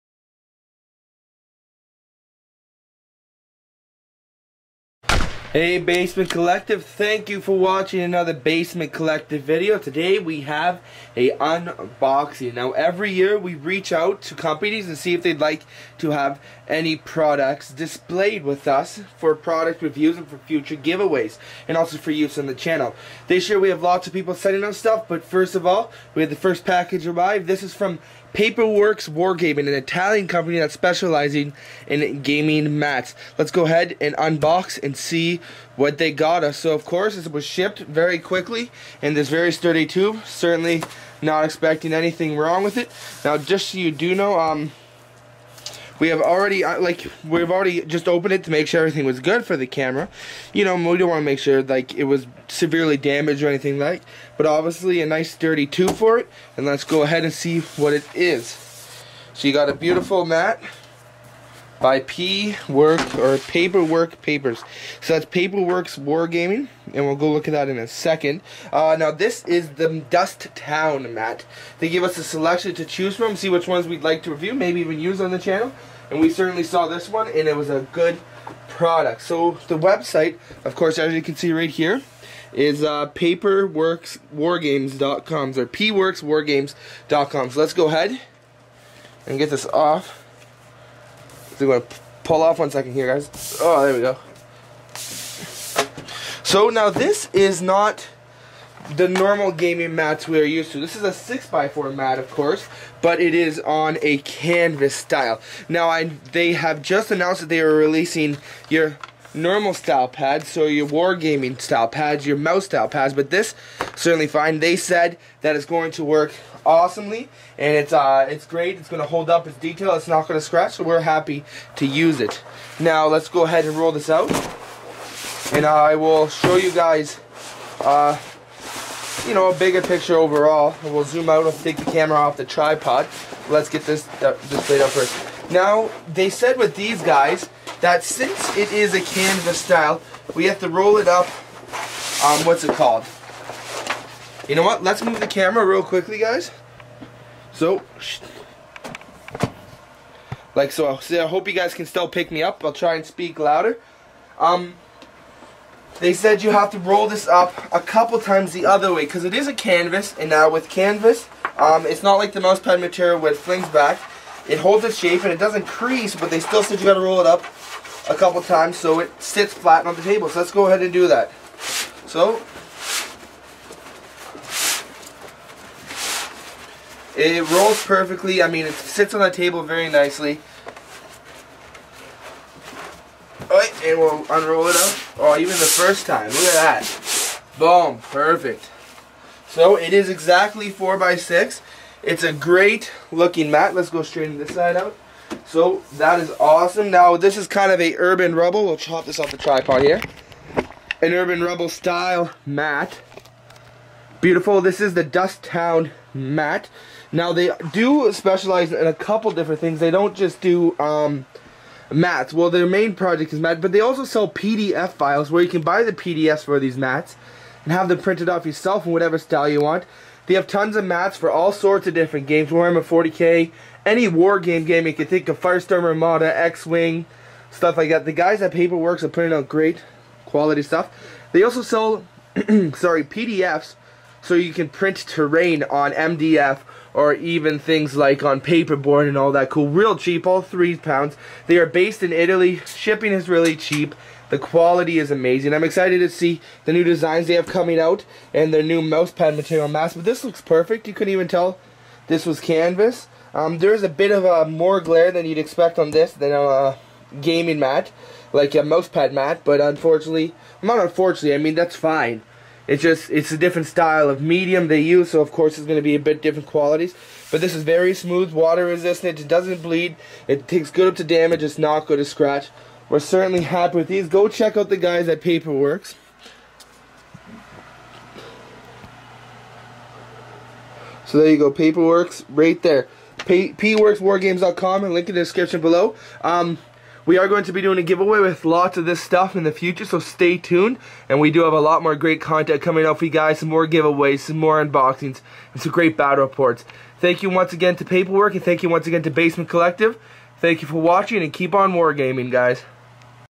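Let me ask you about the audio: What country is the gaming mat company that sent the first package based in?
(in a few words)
Italy.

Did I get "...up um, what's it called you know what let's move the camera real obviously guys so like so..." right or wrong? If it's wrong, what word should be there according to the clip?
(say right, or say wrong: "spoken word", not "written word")
wrong: "quickly", not "obviously".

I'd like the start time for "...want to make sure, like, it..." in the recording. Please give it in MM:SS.
00:51.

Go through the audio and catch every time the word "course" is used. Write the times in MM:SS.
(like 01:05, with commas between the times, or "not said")
00:36, 01:20, 01:42, 04:25.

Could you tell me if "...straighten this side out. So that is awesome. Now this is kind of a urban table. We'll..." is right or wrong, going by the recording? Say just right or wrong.
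wrong.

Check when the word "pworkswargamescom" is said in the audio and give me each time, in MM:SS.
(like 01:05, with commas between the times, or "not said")
01:25, 04:43.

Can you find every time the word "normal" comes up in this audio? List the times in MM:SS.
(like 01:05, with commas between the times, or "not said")
01:39, 01:49.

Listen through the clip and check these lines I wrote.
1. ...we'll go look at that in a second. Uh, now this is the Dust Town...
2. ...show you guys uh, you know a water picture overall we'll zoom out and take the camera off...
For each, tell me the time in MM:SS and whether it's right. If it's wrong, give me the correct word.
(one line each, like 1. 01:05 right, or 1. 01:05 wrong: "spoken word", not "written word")
1. 01:07 right
2. 02:06 wrong: "bigger", not "water".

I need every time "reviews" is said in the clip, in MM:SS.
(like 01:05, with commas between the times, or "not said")
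00:19, 01:14.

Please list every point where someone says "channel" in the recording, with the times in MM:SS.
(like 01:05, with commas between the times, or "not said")
00:22, 01:15.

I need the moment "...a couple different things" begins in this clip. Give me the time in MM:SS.
03:28.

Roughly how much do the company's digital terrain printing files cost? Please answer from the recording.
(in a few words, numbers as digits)
3 pounds.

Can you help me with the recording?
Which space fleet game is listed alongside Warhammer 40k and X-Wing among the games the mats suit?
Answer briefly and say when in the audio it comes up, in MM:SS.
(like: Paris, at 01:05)
Firestorm Armada, at 03:45.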